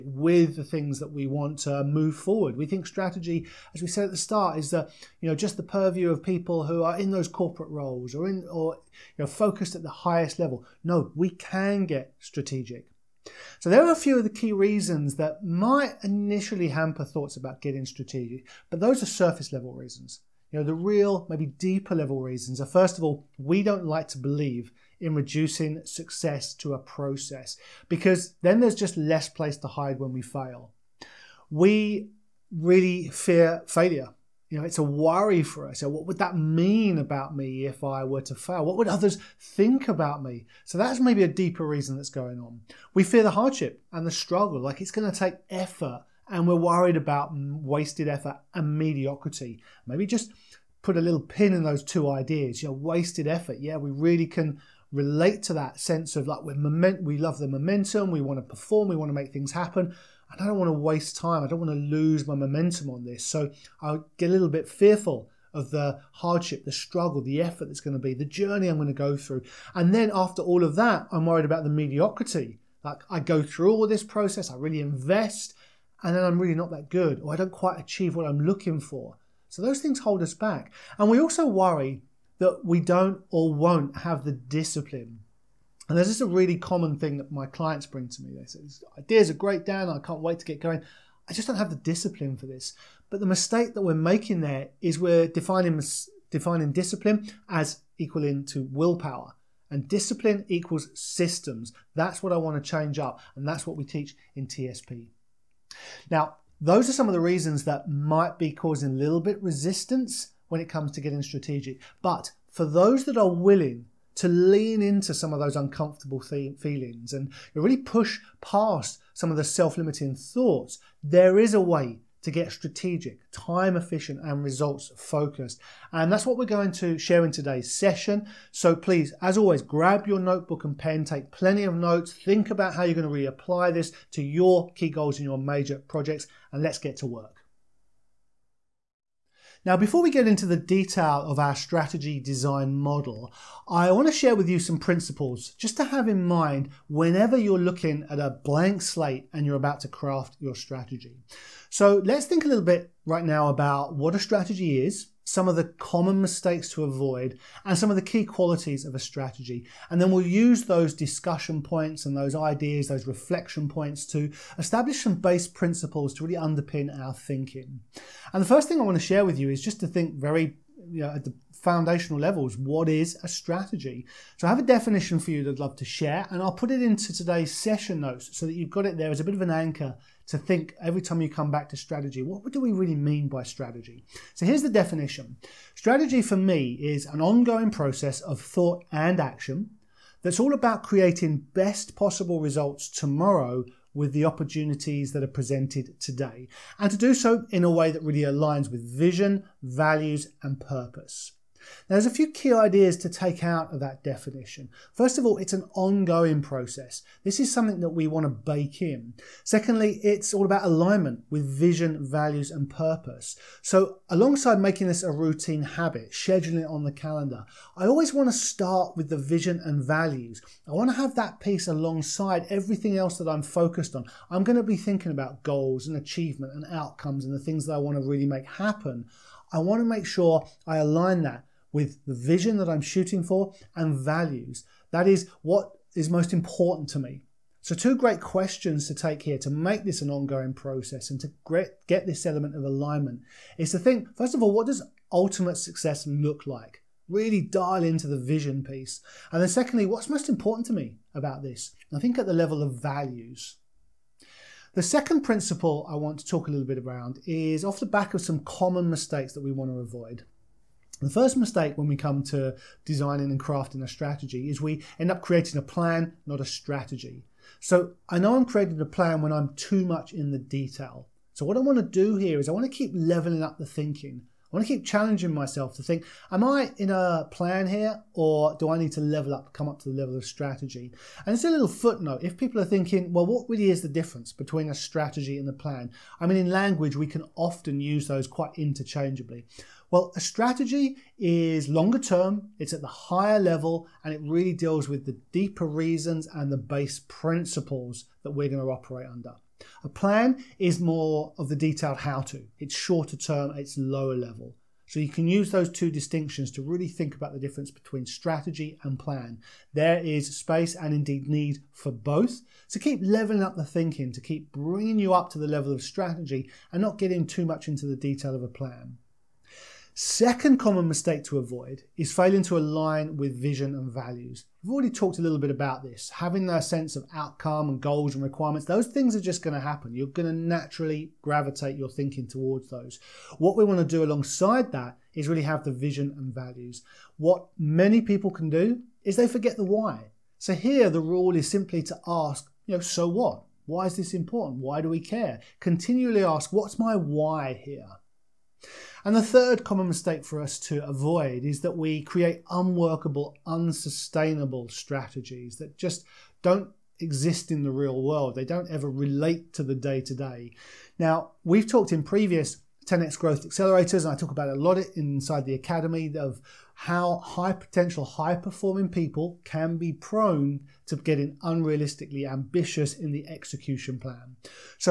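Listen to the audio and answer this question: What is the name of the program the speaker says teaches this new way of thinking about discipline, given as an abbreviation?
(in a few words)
TSP.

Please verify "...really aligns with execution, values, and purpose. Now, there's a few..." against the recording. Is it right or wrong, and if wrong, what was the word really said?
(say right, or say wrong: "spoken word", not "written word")
wrong: "vision", not "execution".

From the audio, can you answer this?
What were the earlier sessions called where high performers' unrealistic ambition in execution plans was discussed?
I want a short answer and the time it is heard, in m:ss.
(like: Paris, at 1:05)
10x growth accelerators, at 6:02.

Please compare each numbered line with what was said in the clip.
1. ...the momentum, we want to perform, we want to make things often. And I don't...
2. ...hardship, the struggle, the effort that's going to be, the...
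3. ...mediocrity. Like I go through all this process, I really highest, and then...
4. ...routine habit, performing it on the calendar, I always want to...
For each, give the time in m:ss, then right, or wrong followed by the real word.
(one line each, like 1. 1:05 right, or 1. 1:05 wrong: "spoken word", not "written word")
1. 0:57 wrong: "happen", not "often"
2. 1:06 right
3. 1:11 wrong: "invest", not "highest"
4. 3:35 wrong: "scheduling", not "performing".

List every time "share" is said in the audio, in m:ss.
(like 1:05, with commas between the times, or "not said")
2:06, 2:24, 2:49, 2:55.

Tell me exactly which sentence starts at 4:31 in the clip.
So what I want to do here is I want to keep leveling up the thinking.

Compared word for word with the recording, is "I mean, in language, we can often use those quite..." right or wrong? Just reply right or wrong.
right.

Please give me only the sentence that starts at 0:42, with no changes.
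We fear the hardship and the struggle, like it's going to take effort, and we're worried about wasted effort and mediocrity.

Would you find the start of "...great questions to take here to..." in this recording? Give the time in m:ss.
3:57.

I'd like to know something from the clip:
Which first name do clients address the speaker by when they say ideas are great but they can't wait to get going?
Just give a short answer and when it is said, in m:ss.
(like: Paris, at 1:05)
Dan, at 1:29.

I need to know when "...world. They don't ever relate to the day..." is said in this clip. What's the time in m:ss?
5:58.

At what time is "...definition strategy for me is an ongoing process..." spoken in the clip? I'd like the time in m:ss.
3:04.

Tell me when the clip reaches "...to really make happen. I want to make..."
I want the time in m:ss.
3:47.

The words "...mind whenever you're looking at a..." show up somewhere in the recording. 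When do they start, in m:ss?
2:26.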